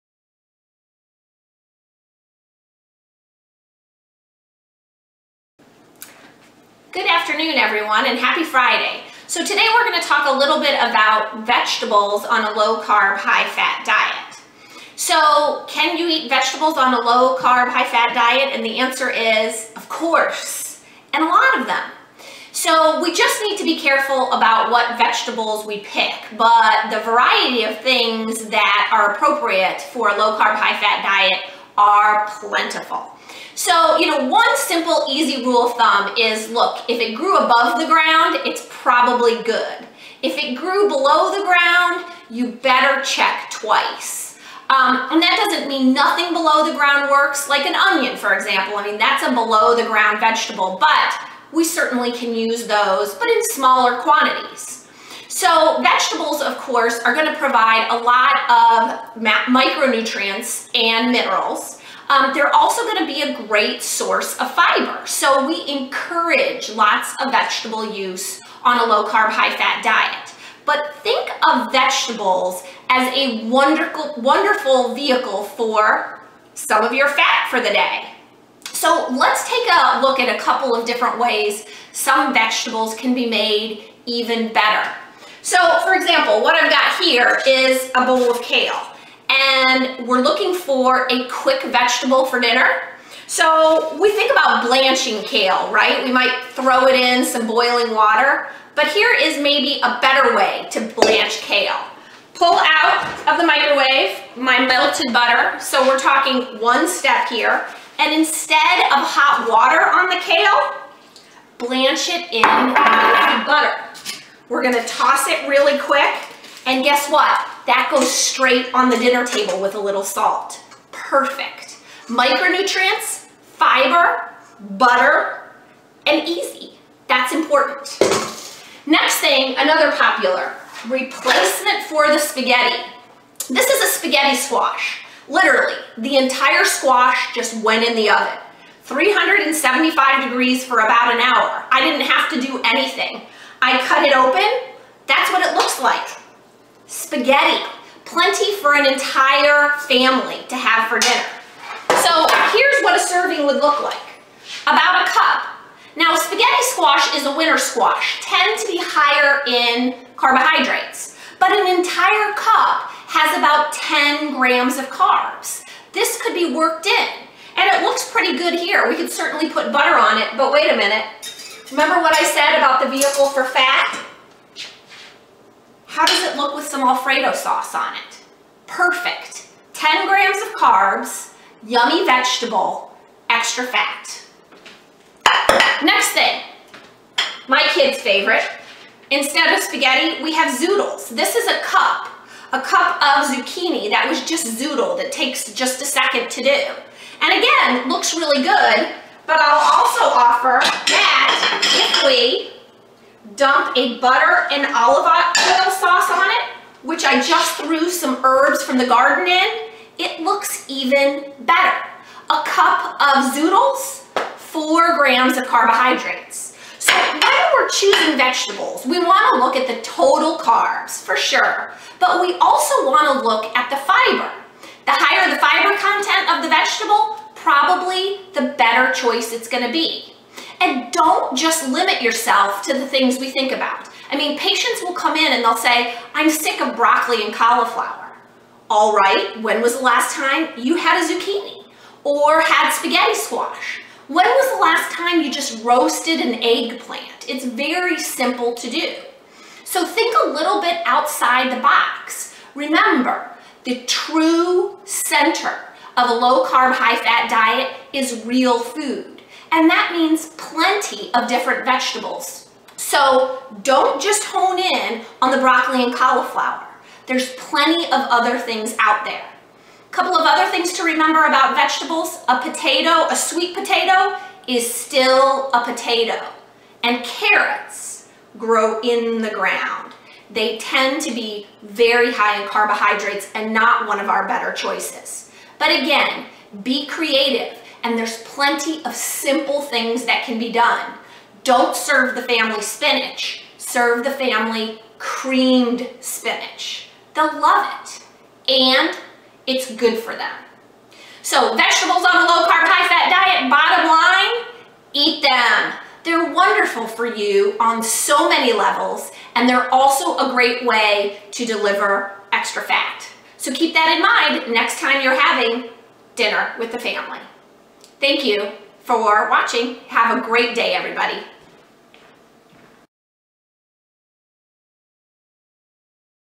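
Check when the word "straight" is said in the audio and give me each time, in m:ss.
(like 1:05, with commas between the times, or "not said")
1:58.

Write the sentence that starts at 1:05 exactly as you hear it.
So we encourage lots of vegetable use on a low carb, high fat diet.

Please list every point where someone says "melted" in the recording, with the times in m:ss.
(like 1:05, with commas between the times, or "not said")
1:44, 1:52.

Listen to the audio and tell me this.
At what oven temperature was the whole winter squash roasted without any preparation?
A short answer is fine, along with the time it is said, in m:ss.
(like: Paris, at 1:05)
375 degrees, at 2:18.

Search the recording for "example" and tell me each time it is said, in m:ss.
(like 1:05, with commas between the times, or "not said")
0:48, 1:25.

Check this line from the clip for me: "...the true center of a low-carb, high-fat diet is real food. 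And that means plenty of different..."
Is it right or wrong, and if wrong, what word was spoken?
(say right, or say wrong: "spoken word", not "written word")
right.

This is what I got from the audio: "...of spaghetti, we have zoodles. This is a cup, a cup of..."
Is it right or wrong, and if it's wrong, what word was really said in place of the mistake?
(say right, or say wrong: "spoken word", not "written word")
right.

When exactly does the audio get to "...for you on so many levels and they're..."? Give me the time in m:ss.
5:06.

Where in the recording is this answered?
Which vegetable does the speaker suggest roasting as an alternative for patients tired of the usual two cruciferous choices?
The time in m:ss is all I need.
4:06.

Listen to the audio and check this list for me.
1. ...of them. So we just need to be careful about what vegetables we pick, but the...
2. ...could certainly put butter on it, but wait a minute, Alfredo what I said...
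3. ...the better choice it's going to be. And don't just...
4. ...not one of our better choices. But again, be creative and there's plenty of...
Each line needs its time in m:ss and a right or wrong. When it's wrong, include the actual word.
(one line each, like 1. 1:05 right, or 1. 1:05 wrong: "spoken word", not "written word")
1. 0:21 right
2. 2:48 wrong: "Remember", not "Alfredo"
3. 3:48 right
4. 4:43 right.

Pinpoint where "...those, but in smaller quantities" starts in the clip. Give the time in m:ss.
0:52.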